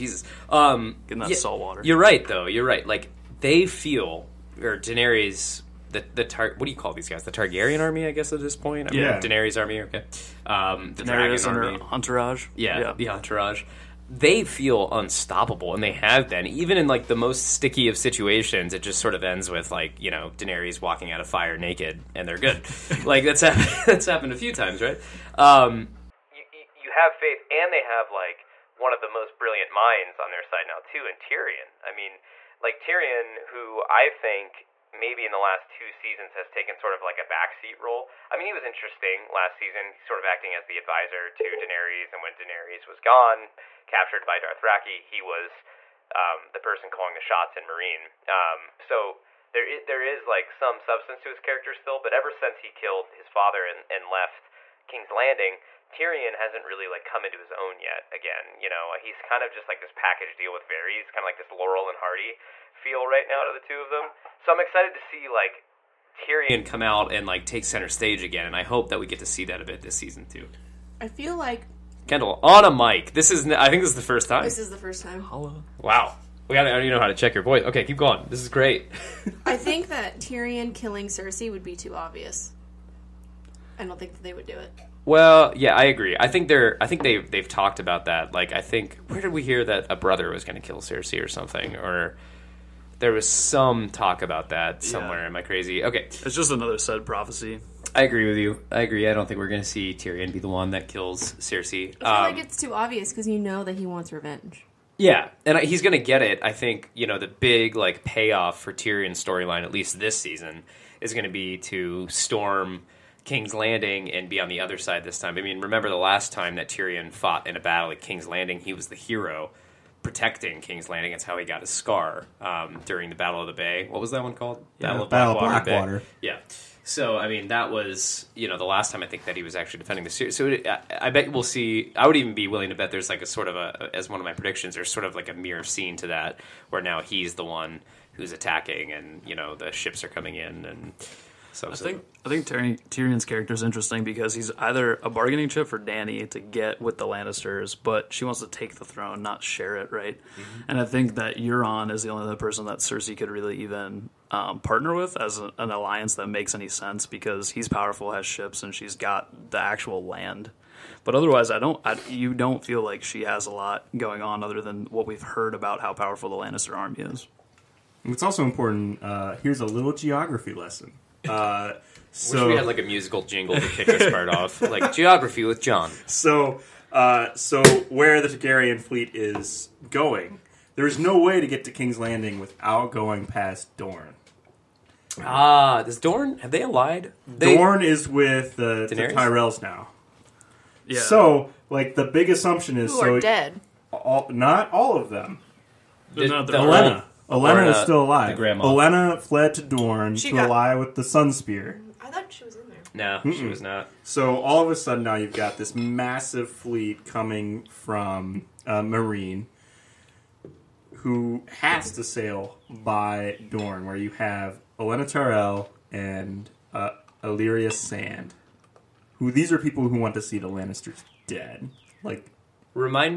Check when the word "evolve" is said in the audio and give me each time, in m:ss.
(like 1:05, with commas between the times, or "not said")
not said.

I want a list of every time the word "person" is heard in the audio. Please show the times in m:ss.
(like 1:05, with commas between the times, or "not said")
0:46, 2:32.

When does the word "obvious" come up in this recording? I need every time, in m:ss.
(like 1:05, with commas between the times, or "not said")
1:21, 1:42.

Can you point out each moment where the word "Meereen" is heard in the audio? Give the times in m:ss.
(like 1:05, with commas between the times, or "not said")
0:47, 3:28.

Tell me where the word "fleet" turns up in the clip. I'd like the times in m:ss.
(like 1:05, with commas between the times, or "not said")
2:58, 3:26.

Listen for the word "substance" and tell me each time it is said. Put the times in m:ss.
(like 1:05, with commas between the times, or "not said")
0:50.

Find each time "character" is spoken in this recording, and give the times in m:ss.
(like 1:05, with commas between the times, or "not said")
0:51, 2:23.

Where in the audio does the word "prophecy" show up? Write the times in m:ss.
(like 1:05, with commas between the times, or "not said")
1:37.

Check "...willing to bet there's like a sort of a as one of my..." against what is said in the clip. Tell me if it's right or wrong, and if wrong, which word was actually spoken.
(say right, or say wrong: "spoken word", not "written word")
right.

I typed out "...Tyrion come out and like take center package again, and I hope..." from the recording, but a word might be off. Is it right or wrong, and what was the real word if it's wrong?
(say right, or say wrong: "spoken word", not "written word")
wrong: "stage", not "package".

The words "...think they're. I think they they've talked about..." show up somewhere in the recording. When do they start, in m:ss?
1:26.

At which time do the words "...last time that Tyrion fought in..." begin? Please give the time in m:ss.
1:55.